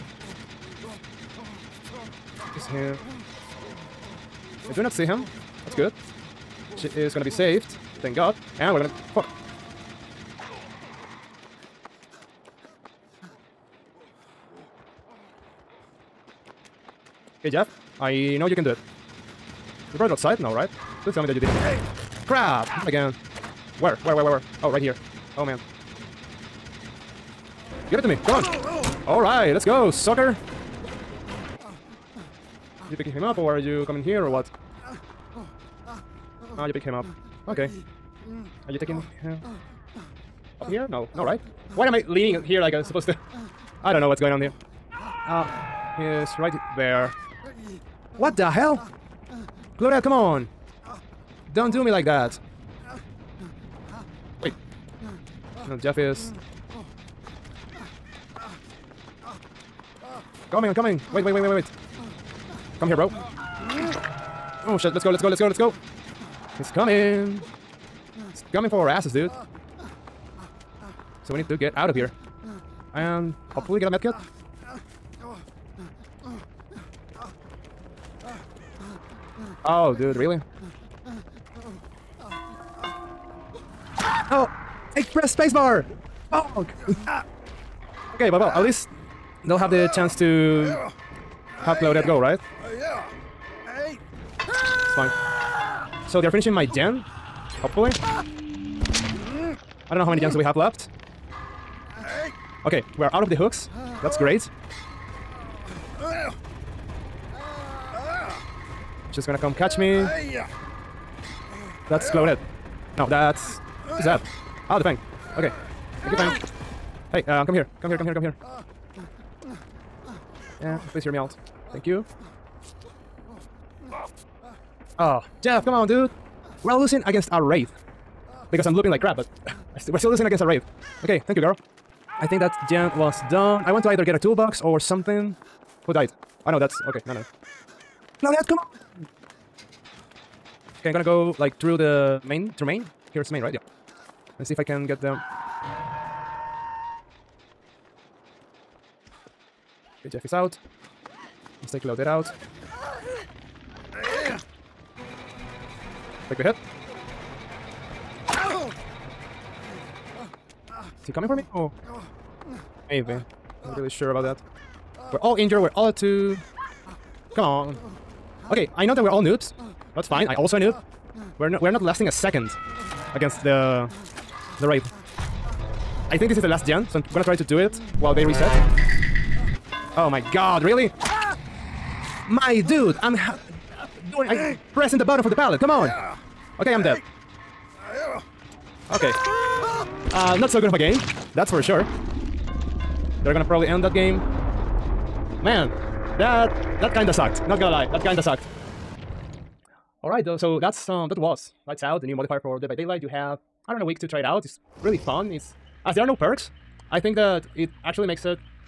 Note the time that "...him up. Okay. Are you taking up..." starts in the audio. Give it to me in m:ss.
0:36.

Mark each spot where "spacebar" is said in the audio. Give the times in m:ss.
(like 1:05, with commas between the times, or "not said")
1:25.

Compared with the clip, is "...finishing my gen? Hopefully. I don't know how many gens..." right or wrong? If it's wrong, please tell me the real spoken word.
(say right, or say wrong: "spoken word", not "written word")
right.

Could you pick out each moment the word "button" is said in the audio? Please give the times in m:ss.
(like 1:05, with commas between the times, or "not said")
3:05.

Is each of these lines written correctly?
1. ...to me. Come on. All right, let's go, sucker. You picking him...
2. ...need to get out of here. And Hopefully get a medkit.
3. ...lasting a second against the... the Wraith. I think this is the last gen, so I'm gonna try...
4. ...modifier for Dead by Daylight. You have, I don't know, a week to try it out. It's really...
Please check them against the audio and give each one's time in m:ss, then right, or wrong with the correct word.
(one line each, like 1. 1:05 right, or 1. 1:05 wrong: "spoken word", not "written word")
1. 0:28 right
2. 1:11 right
3. 2:51 right
4. 3:22 right.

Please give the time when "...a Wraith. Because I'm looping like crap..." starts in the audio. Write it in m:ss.
2:07.